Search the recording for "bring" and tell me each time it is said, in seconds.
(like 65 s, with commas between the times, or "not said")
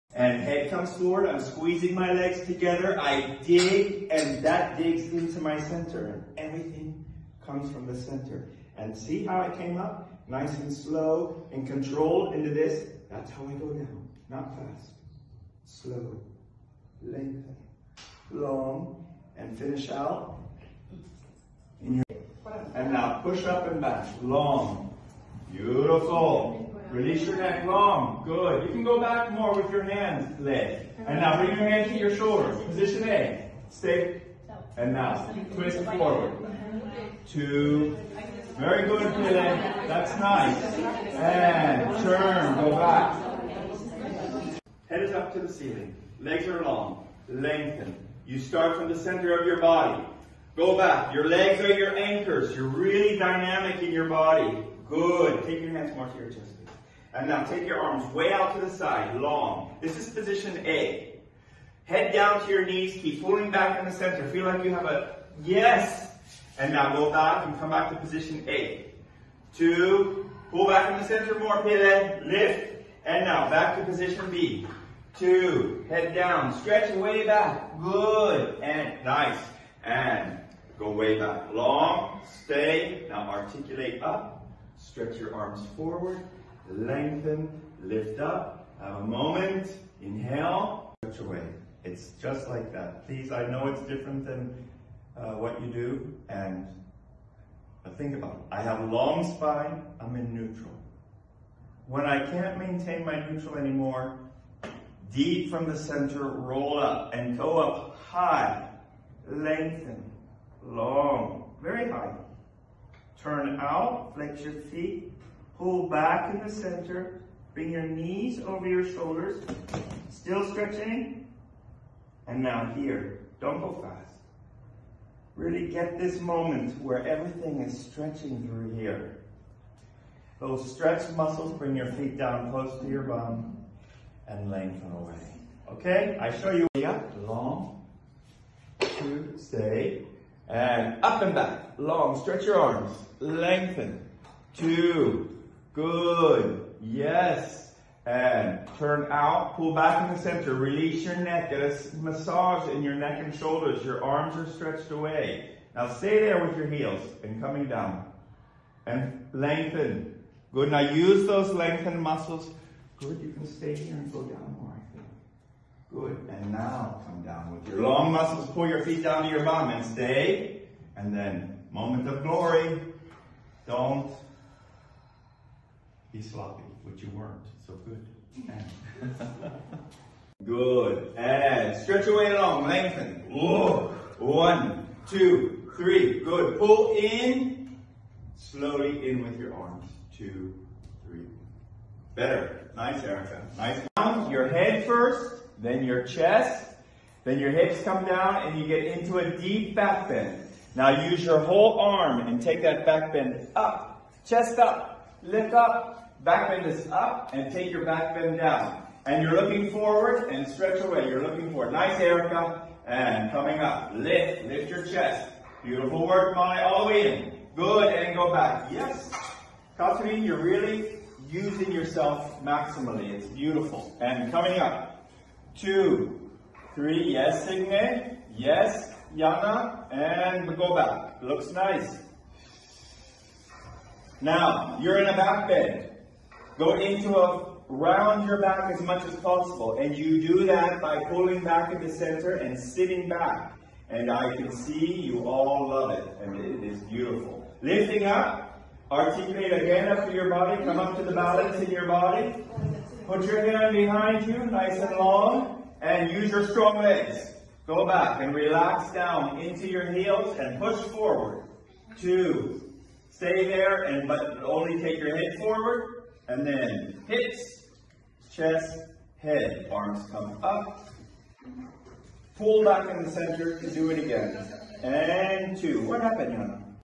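31 s, 117 s, 131 s.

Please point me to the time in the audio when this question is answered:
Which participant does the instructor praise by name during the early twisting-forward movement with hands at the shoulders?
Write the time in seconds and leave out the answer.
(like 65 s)
39 s.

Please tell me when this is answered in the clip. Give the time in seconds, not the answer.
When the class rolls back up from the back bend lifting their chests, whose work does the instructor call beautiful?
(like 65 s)
216 s.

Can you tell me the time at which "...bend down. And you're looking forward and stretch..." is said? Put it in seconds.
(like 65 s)
208 s.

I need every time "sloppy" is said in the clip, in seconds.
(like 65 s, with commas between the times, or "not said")
176 s.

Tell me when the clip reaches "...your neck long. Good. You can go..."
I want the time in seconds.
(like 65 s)
27 s.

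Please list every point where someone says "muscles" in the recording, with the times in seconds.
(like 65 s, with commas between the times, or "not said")
131 s, 162 s, 168 s.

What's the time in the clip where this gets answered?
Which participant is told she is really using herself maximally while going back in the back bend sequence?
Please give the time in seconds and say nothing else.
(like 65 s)
219 s.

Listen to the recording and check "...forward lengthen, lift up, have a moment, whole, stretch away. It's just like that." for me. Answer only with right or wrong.
wrong.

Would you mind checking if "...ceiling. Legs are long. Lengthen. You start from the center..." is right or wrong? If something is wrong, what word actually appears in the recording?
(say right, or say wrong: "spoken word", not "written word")
right.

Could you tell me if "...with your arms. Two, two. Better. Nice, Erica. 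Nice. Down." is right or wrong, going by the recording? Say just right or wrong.
wrong.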